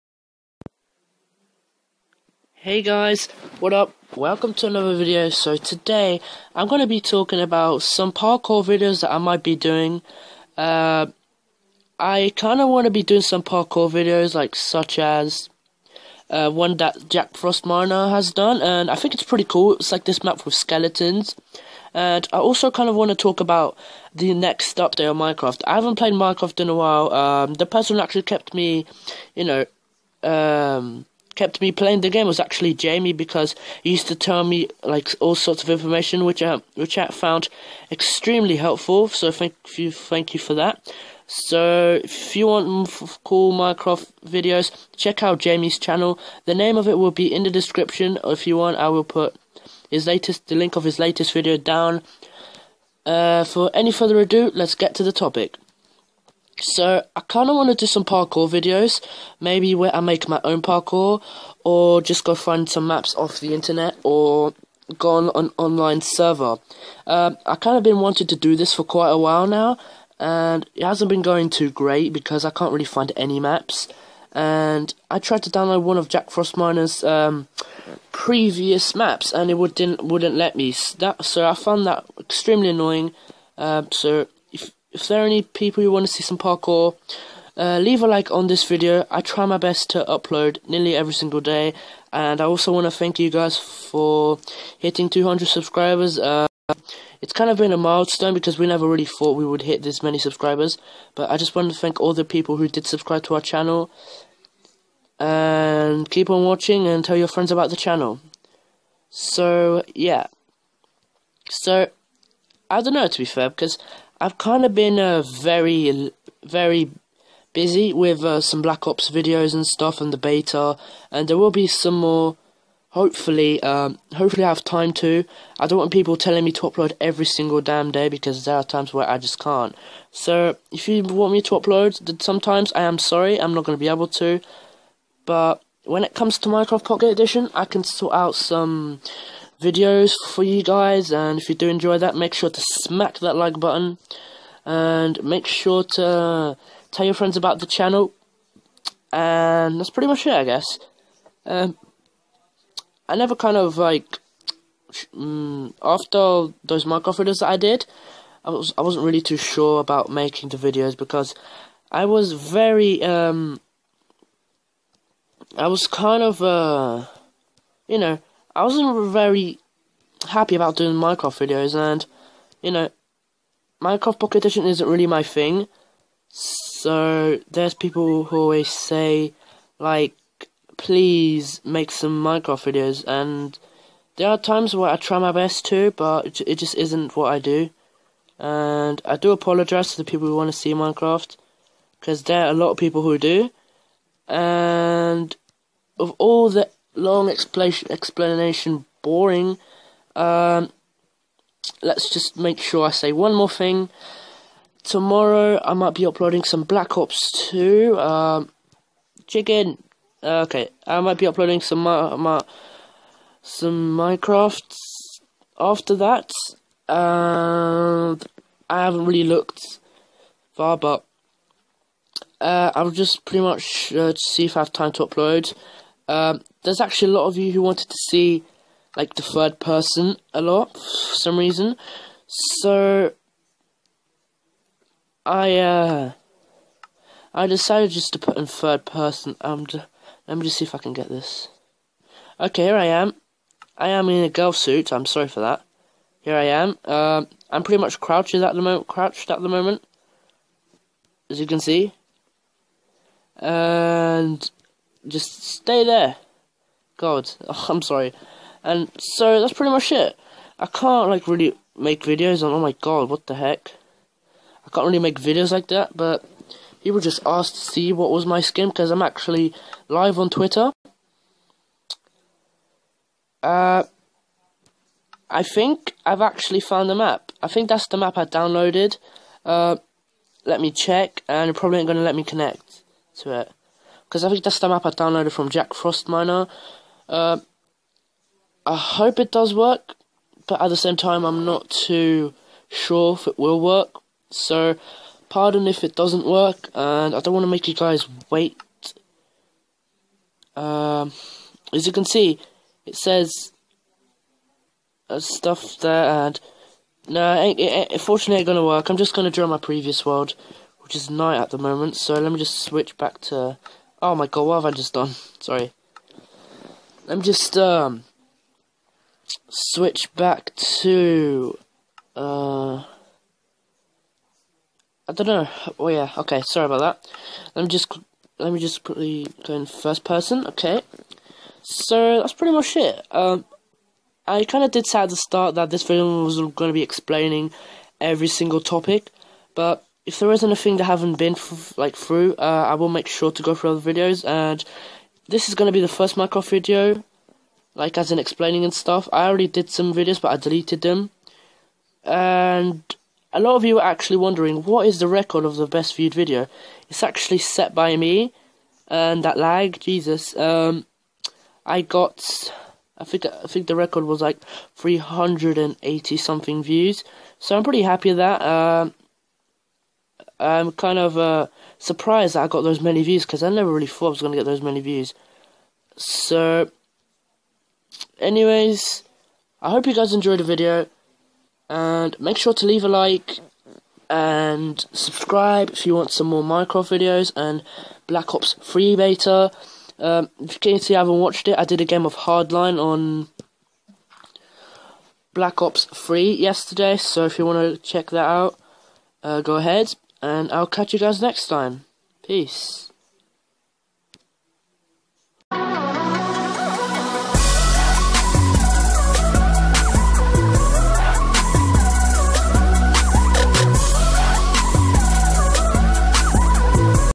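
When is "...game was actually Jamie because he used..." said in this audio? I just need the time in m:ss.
0:32.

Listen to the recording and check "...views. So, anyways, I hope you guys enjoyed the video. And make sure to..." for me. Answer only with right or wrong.
right.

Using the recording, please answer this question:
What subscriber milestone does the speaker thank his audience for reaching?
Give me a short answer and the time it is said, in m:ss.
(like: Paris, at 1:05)
200, at 1:35.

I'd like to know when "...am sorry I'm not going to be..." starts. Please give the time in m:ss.
2:12.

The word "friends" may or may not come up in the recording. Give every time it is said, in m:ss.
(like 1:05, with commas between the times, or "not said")
1:47, 2:27.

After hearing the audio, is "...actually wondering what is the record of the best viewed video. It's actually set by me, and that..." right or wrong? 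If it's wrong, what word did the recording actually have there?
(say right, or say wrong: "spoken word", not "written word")
right.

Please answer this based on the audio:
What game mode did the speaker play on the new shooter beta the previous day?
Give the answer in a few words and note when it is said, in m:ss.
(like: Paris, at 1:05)
Hardline, at 6:32.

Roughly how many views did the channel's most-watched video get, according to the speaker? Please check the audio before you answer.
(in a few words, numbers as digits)
380.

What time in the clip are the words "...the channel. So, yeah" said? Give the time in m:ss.
1:47.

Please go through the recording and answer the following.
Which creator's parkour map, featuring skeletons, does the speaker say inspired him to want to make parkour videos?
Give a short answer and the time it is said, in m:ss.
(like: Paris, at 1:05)
Jack Frost Miner, at 0:17.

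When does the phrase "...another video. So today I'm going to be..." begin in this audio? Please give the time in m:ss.
0:04.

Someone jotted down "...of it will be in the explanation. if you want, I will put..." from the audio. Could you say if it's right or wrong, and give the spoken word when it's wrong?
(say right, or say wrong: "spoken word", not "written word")
wrong: "description", not "explanation".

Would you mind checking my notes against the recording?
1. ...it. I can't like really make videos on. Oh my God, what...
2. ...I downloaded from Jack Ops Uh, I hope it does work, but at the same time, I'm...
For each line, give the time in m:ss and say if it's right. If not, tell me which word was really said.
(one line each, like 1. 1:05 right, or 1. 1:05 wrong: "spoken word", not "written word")
1. 4:19 right
2. 4:44 wrong: "Frost", not "Ops".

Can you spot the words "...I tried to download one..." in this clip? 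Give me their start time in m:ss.
1:15.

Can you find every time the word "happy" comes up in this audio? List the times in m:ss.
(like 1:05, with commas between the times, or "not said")
2:50, 6:07.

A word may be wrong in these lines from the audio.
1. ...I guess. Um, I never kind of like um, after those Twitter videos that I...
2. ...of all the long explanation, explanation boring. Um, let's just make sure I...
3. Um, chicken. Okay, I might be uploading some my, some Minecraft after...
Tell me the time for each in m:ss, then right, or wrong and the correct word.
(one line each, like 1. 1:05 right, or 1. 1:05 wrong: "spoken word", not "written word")
1. 2:30 wrong: "Minecraft", not "Twitter"
2. 3:15 right
3. 3:27 right.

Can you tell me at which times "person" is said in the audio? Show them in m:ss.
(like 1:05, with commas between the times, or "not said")
0:27, 3:49, 3:58, 5:30.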